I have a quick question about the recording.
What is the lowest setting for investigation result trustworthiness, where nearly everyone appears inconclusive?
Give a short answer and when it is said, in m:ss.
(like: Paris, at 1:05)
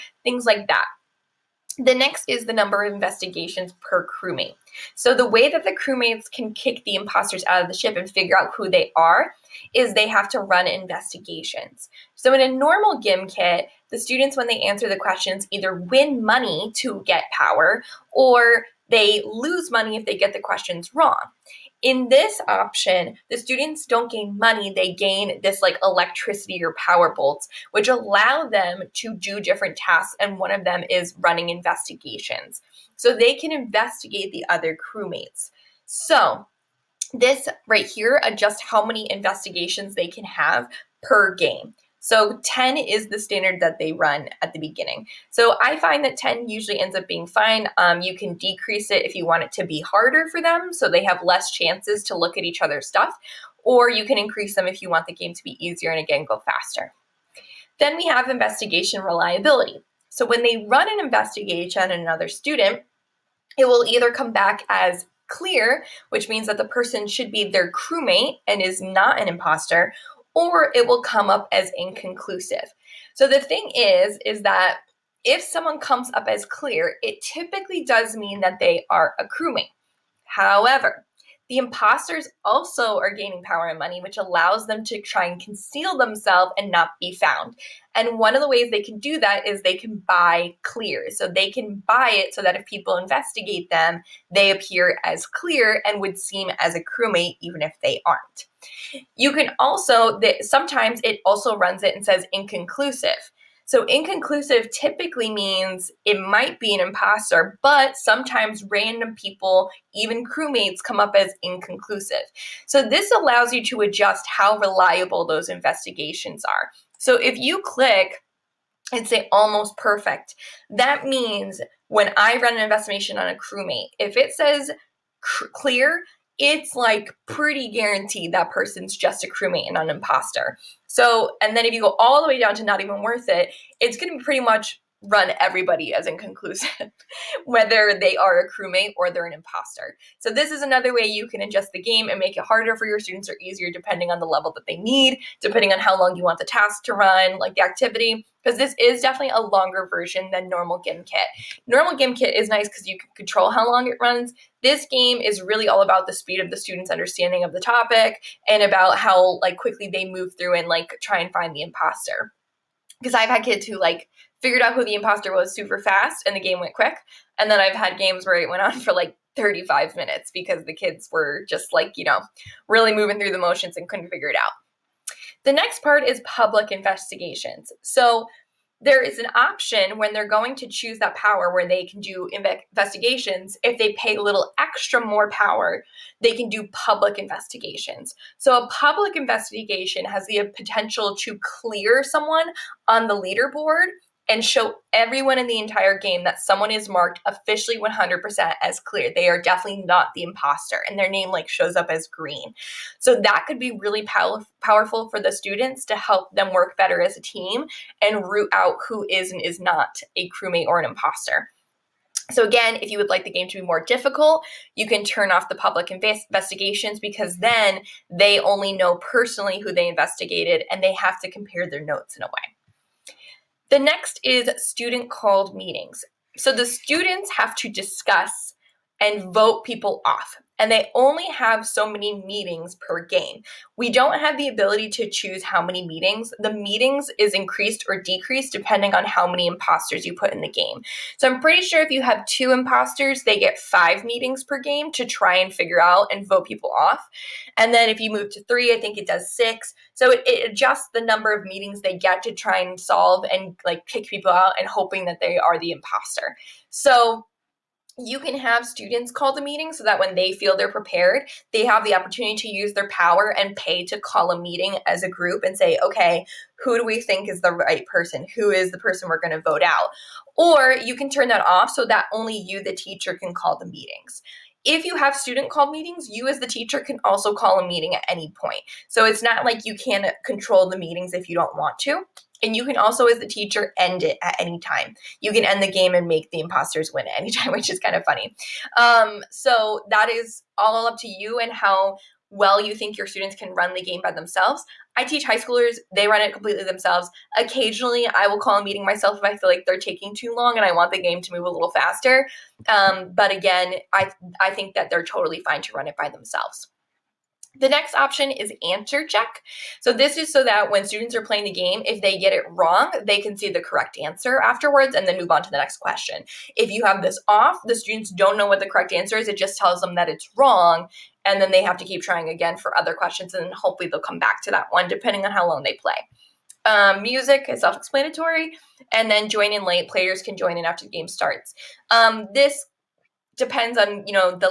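not even worth it, at 2:12.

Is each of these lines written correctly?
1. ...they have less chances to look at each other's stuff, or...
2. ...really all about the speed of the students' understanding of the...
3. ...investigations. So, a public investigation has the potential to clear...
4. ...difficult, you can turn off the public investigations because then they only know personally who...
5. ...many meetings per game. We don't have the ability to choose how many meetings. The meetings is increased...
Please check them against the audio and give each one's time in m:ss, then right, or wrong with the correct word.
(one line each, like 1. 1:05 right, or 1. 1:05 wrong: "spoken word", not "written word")
1. 0:50 right
2. 2:35 right
3. 3:07 right
4. 3:33 right
5. 3:51 right.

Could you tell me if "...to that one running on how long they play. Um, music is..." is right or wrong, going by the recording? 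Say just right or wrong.
wrong.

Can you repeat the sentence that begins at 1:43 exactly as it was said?
So, inconclusive typically means it might be an imposter, but sometimes random people, even crewmates, come up as inconclusive.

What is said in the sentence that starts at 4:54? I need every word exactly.
I teach high schoolers, they run it completely themselves.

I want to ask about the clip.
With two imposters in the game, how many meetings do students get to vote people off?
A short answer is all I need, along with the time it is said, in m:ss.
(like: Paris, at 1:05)
5, at 4:03.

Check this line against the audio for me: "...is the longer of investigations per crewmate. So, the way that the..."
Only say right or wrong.
wrong.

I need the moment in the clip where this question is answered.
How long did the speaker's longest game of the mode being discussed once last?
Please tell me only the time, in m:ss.
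2:49.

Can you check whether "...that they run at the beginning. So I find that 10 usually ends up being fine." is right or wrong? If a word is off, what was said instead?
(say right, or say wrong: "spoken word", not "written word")
right.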